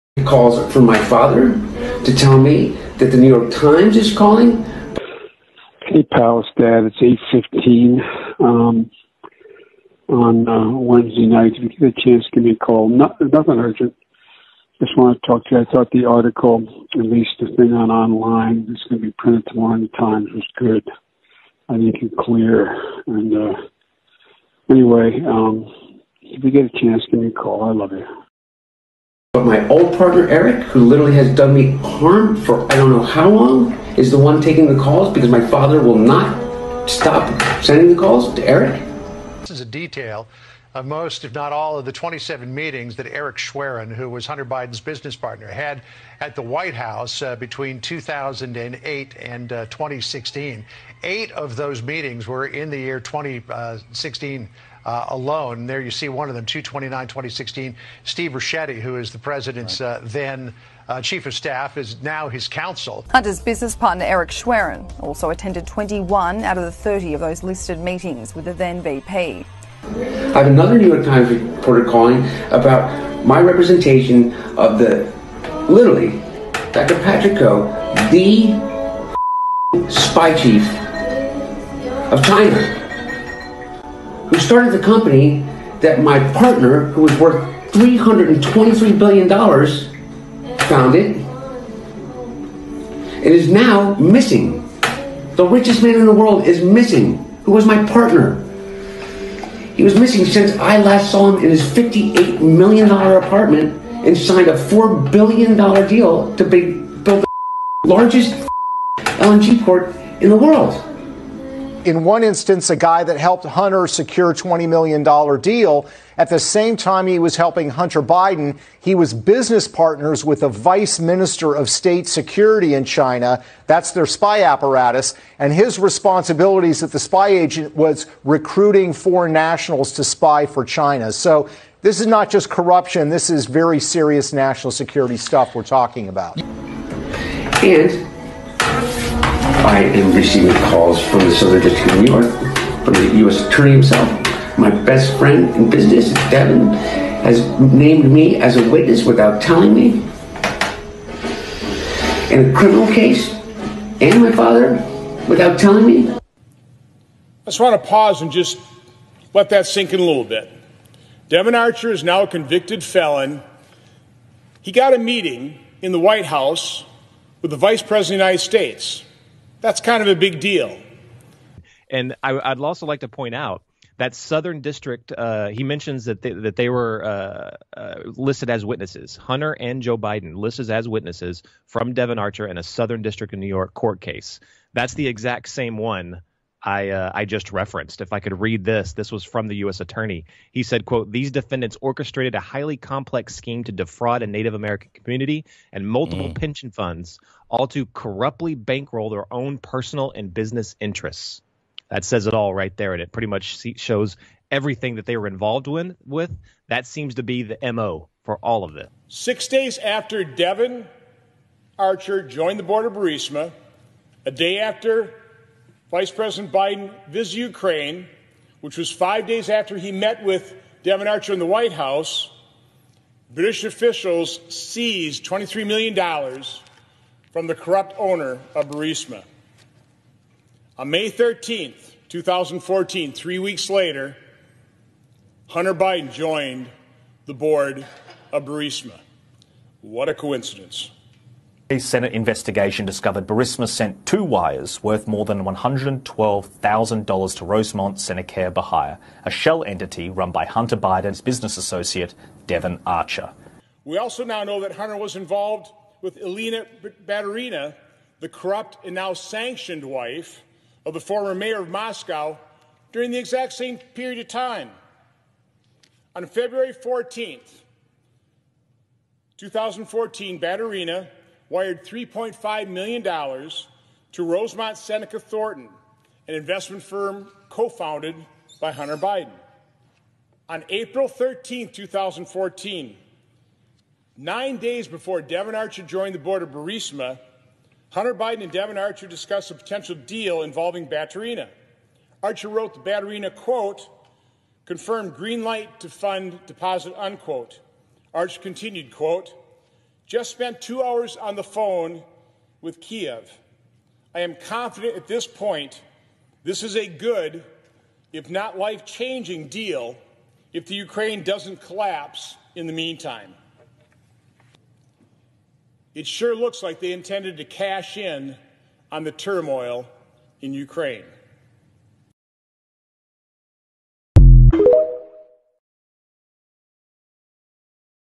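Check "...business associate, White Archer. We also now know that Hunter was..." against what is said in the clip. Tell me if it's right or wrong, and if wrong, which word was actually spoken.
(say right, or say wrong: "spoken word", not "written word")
wrong: "Devon", not "White".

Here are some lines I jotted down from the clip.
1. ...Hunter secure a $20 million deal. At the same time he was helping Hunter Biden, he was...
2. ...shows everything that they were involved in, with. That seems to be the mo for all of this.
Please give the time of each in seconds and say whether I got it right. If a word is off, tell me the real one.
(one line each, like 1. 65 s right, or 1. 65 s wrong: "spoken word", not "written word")
1. 113 s right
2. 203 s right.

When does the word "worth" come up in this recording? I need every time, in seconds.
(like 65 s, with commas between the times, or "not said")
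87 s, 244 s.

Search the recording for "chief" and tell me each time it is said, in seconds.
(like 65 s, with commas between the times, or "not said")
61 s, 80 s.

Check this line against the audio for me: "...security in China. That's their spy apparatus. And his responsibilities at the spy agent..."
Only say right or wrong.
right.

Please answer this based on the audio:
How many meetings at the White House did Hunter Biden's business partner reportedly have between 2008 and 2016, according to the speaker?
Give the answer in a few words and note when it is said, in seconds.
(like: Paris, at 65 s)
27, at 41 s.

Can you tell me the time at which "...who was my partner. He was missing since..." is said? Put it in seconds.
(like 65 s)
97 s.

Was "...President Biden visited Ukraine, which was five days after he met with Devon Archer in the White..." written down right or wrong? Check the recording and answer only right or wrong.
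right.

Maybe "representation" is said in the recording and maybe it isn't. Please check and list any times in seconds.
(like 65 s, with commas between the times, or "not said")
73 s.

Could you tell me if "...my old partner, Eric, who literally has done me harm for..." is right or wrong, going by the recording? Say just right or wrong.
right.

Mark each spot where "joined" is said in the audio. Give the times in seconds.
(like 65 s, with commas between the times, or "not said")
212 s, 236 s, 285 s.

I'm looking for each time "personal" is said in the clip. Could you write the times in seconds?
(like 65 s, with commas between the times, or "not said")
199 s.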